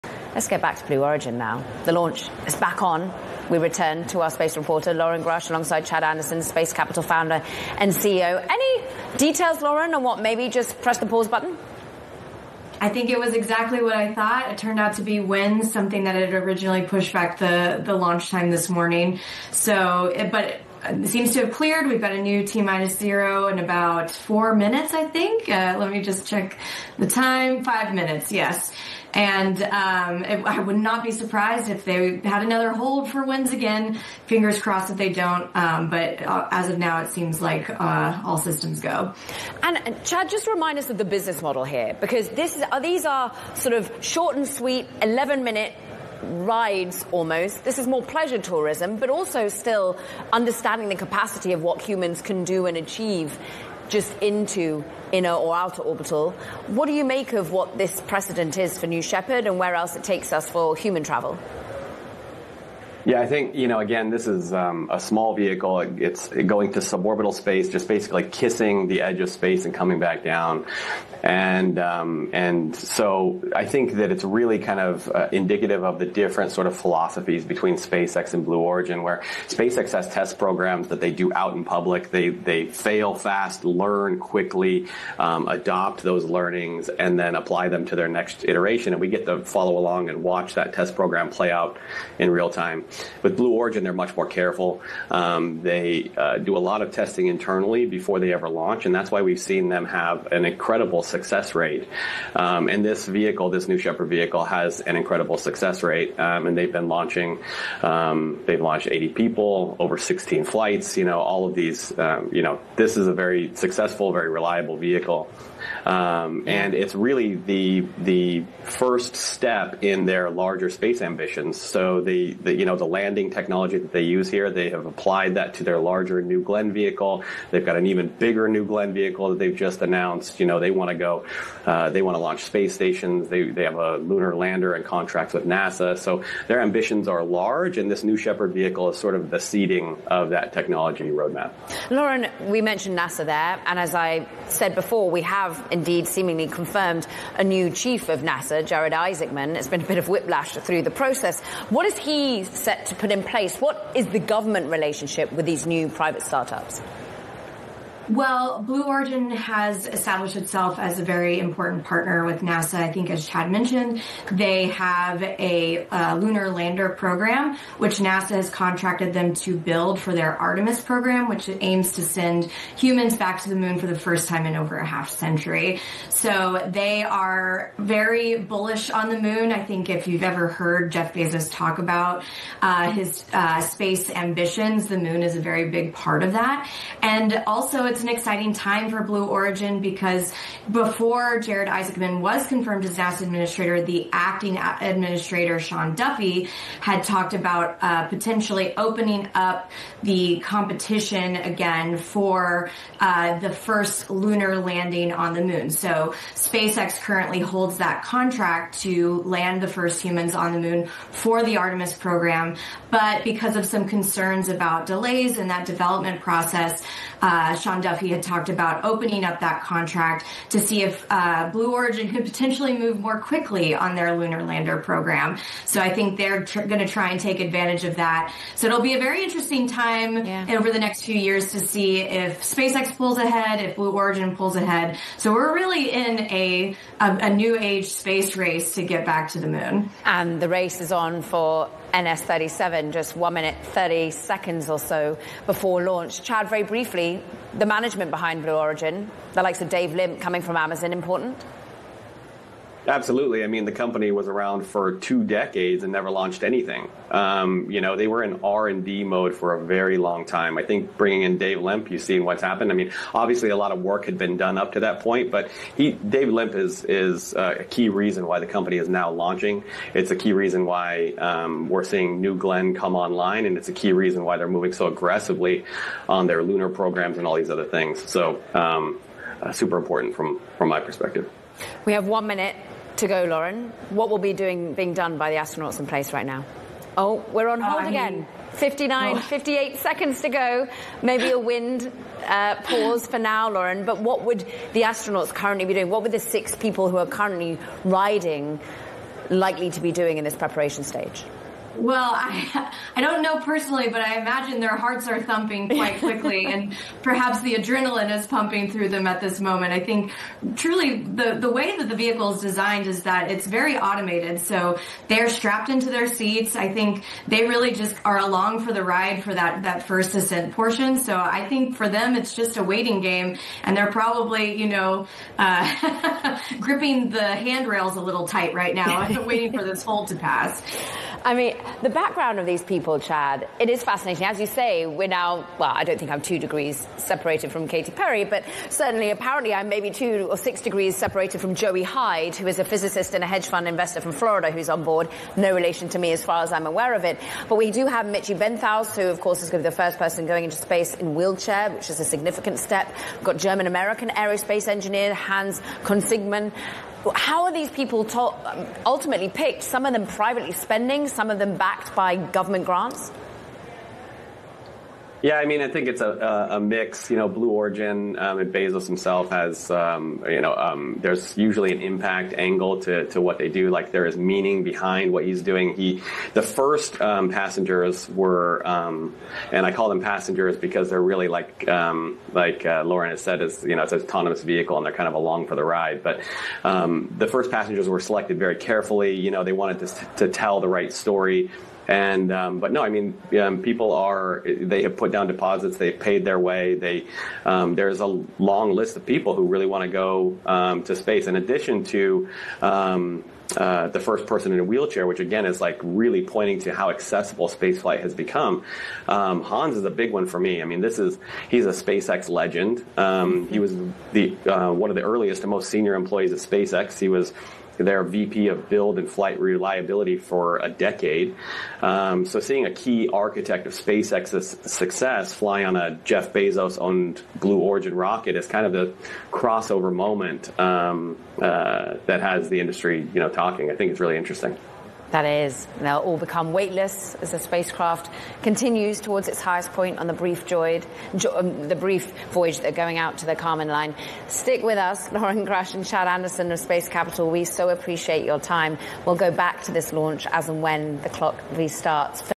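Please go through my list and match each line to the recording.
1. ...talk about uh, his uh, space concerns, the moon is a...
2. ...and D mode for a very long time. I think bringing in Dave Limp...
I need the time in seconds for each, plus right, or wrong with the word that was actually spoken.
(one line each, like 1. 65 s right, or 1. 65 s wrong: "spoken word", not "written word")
1. 181 s wrong: "ambitions", not "concerns"
2. 258 s right.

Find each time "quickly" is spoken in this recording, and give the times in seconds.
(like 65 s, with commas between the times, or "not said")
84 s, 223 s, 305 s.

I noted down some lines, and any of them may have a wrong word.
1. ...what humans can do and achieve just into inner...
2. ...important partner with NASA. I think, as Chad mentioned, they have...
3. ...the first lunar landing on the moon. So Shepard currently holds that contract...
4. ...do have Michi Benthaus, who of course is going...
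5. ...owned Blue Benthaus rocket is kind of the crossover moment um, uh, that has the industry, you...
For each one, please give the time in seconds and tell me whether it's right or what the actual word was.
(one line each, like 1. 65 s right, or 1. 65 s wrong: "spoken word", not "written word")
1. 51 s right
2. 161 s right
3. 203 s wrong: "SpaceX", not "Shepard"
4. 347 s right
5. 426 s wrong: "Origin", not "Benthaus".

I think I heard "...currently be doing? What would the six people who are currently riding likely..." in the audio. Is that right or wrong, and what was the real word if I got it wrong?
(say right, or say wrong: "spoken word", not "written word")
right.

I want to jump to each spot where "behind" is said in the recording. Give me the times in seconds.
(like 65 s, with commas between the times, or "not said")
248 s, 374 s.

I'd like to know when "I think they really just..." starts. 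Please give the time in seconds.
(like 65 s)
316 s.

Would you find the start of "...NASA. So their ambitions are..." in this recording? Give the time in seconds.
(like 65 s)
135 s.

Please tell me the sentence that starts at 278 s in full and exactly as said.
So, um, uh, super important from from my perspective.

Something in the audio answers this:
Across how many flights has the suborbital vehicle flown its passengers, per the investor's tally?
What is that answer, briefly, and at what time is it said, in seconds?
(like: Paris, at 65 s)
16, at 109 s.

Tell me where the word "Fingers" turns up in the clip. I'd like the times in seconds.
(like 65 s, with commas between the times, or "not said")
34 s.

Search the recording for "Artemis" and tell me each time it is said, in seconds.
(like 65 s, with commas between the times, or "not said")
170 s, 211 s.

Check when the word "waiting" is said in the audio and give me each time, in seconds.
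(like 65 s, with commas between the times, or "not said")
322 s, 329 s.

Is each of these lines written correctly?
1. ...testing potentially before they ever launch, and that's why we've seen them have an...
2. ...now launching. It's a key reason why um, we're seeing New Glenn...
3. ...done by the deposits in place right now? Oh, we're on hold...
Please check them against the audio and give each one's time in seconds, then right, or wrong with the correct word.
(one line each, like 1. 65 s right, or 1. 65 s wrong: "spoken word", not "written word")
1. 96 s wrong: "internally", not "potentially"
2. 268 s right
3. 284 s wrong: "astronauts", not "deposits".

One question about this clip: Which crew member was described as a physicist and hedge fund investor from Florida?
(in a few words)
Joey Hyde.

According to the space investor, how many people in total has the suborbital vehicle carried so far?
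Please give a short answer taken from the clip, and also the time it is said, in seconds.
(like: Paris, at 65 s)
80, at 108 s.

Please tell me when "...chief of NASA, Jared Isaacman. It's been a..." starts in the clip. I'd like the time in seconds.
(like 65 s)
147 s.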